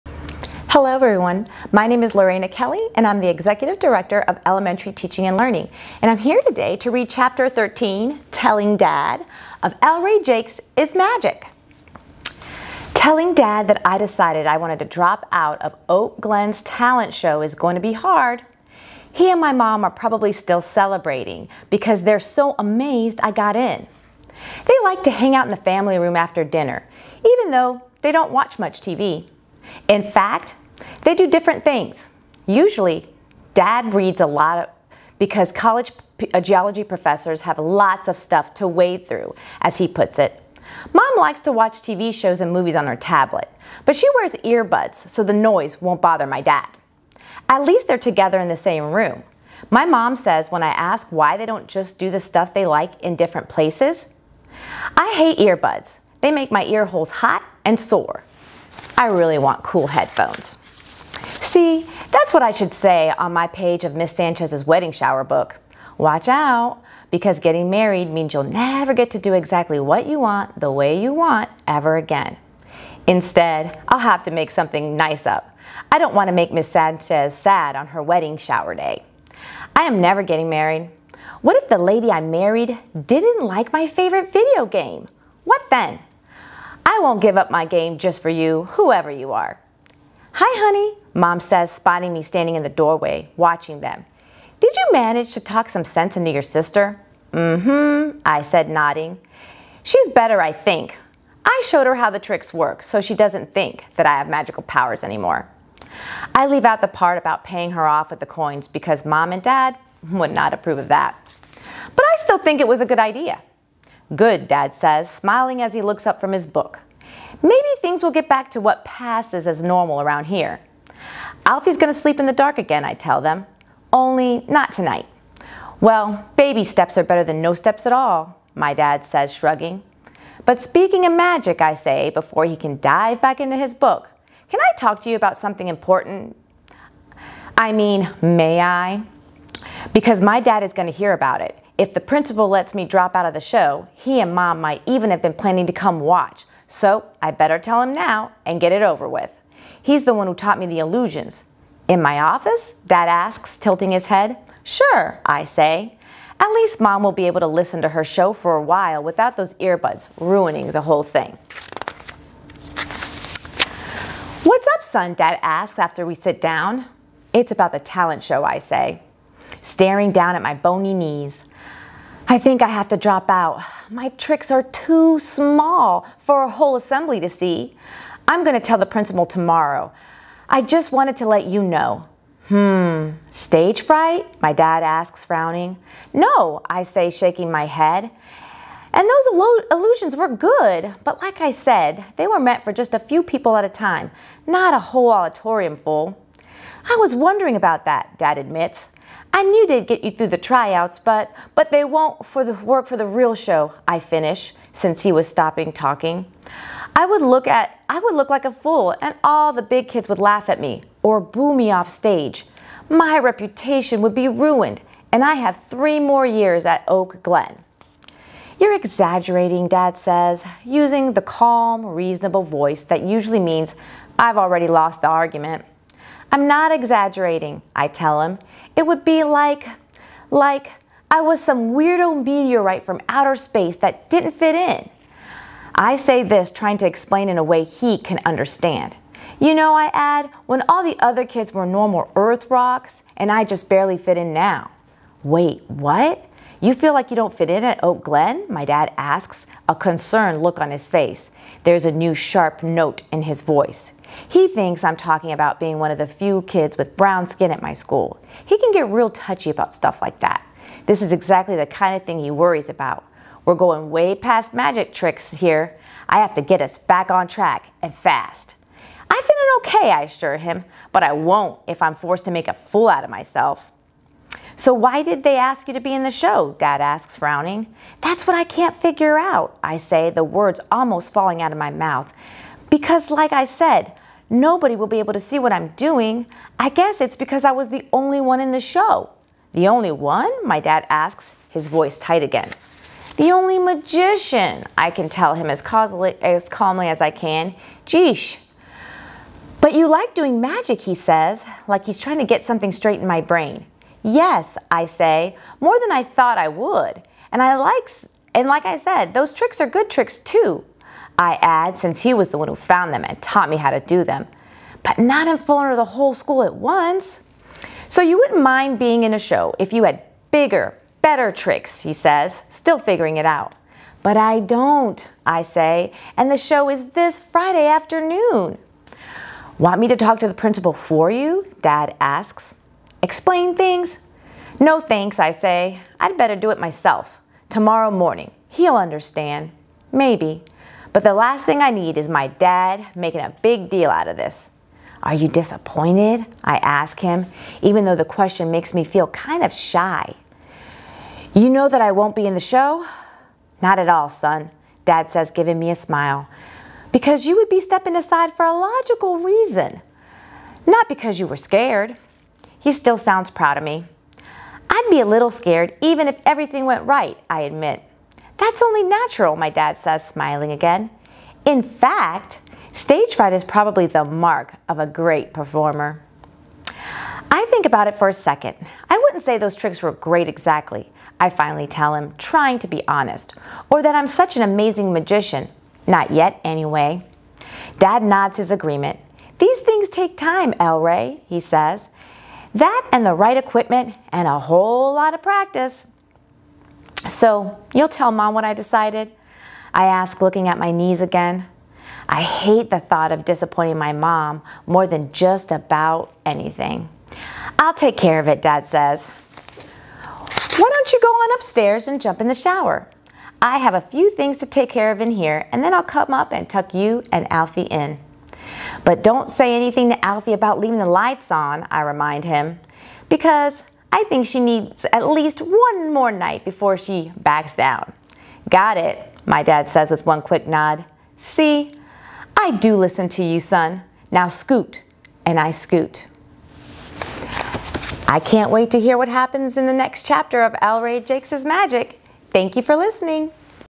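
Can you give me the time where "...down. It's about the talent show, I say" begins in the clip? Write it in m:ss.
2:46.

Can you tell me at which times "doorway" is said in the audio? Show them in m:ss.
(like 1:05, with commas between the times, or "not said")
1:32.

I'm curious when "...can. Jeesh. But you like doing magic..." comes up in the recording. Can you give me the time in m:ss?
4:57.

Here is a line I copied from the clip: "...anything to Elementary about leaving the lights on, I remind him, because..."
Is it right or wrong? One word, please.
wrong.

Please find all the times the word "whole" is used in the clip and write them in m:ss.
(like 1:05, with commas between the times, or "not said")
2:40, 2:56, 3:14, 5:15, 6:34.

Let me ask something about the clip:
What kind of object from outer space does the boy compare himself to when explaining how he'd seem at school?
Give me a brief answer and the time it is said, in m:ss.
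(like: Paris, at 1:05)
Meteorite, at 3:52.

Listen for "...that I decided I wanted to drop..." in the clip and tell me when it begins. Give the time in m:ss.
0:13.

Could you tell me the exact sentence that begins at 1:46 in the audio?
I leave out the part about paying her off with the coins because mom and dad would not approve of that.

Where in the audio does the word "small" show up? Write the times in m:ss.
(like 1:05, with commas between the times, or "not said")
2:55.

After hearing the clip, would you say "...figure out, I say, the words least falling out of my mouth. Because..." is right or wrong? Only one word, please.
wrong.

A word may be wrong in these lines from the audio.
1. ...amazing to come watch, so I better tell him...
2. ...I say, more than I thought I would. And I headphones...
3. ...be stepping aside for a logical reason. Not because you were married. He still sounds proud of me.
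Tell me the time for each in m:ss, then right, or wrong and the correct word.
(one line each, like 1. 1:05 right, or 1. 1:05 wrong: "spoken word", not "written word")
1. 2:25 wrong: "planning", not "amazing"
2. 5:04 wrong: "likes", not "headphones"
3. 5:57 wrong: "scared", not "married".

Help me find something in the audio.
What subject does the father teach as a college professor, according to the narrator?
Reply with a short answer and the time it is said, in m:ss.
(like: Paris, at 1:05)
Geology, at 0:36.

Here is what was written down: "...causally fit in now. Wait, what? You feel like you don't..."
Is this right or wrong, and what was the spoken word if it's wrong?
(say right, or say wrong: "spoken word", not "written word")
wrong: "barely", not "causally".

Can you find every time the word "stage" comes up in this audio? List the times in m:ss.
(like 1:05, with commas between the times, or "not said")
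3:03, 3:31, 6:12.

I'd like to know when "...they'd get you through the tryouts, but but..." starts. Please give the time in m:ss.
3:19.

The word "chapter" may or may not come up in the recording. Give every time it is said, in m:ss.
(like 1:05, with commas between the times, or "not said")
0:07, 7:20.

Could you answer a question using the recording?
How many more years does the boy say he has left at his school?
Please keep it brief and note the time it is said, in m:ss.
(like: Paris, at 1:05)
3, at 3:35.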